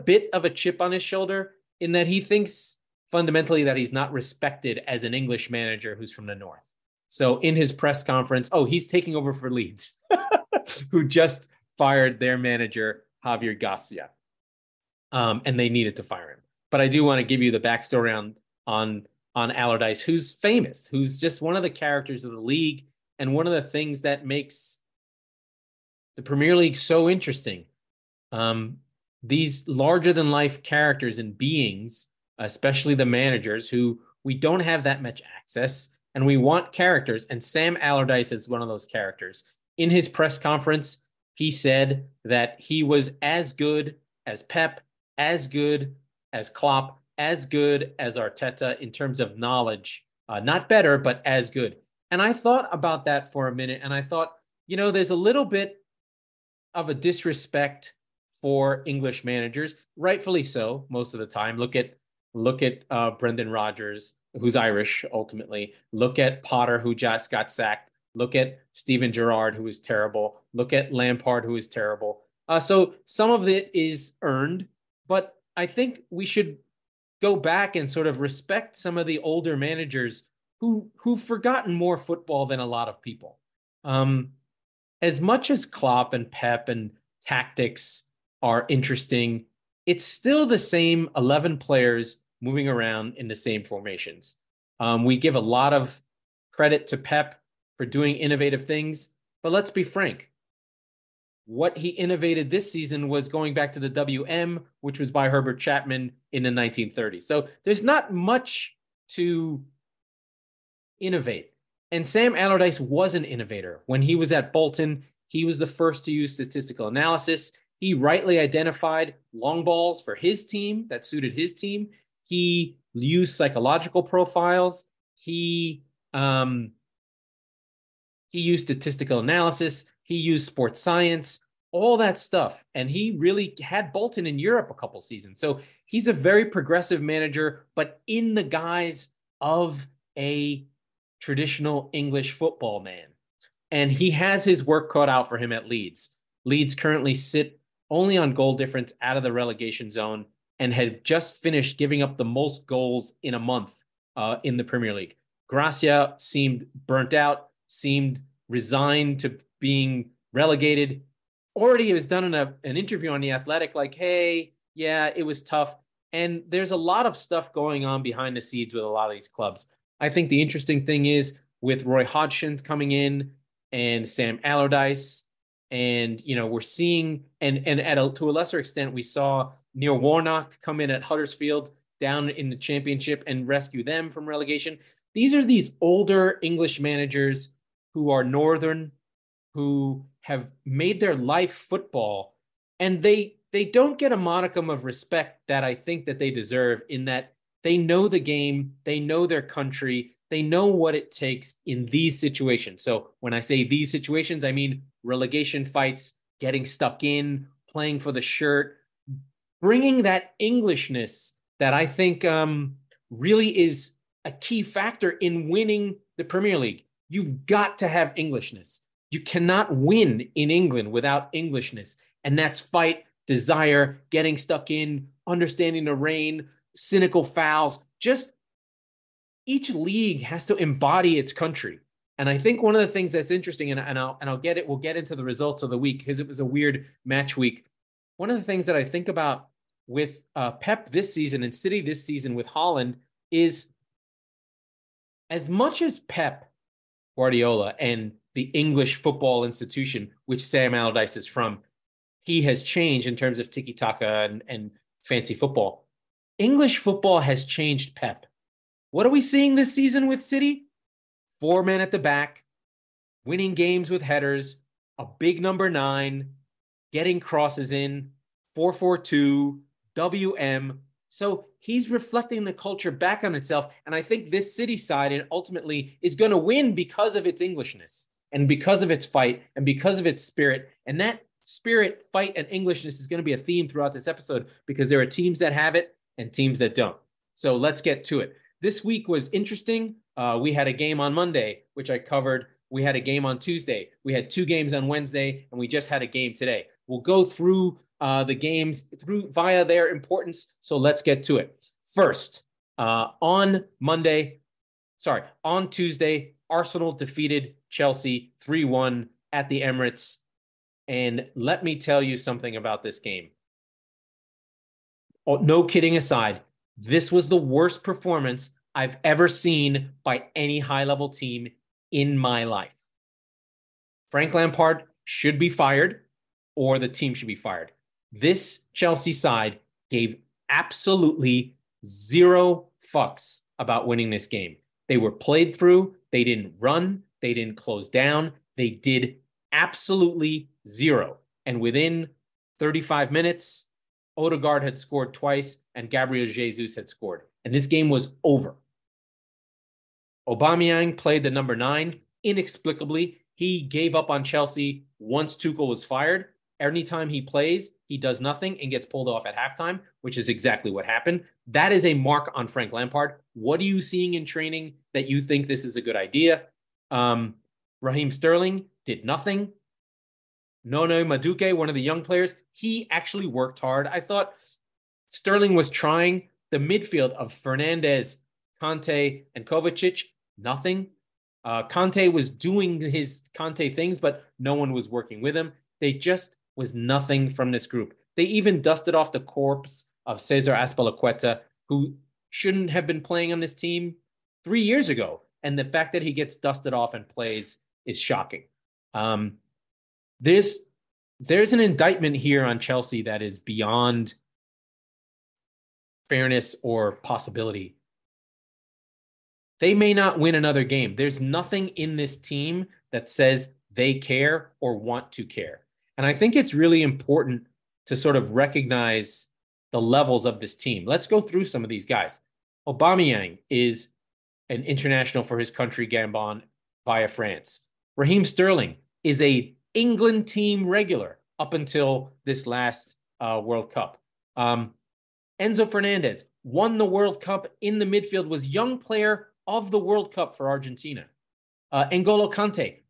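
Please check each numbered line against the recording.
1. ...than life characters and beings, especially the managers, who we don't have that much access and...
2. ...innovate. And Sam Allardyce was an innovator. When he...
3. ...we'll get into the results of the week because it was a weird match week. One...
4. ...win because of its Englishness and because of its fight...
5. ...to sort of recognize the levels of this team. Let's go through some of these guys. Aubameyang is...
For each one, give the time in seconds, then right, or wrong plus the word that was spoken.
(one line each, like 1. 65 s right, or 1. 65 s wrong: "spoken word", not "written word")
1. 30 s right
2. 110 s right
3. 234 s right
4. 276 s right
5. 417 s right.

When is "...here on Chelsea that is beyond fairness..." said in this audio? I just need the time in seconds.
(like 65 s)
402 s.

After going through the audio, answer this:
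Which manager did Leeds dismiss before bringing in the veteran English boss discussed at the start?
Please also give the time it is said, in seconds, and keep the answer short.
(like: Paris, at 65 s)
Javier Gracia, at 13 s.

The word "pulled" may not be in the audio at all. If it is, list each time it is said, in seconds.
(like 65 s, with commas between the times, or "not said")
358 s.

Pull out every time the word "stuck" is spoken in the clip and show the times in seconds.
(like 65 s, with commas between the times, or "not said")
206 s, 224 s.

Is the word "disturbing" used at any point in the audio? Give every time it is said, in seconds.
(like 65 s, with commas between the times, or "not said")
not said.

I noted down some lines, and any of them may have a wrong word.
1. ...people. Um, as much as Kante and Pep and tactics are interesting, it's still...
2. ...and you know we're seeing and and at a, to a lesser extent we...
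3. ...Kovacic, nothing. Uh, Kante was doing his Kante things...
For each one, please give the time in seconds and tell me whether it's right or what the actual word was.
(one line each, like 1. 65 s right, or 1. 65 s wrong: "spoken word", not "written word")
1. 83 s wrong: "Klopp", not "Kante"
2. 175 s right
3. 379 s right.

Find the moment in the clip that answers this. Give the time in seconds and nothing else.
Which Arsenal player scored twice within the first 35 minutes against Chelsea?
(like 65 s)
344 s.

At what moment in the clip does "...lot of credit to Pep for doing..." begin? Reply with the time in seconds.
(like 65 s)
95 s.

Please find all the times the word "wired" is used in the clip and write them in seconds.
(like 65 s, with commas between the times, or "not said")
not said.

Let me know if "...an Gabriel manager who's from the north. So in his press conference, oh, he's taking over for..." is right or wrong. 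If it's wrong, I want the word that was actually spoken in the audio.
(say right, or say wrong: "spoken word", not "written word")
wrong: "English", not "Gabriel".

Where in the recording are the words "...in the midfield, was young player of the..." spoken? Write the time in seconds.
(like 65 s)
437 s.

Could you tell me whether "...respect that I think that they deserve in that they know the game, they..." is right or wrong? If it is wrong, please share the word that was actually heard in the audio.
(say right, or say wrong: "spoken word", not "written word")
right.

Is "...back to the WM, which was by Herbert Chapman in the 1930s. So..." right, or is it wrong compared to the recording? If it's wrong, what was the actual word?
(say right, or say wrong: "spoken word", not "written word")
right.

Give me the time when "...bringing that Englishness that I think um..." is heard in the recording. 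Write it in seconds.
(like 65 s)
209 s.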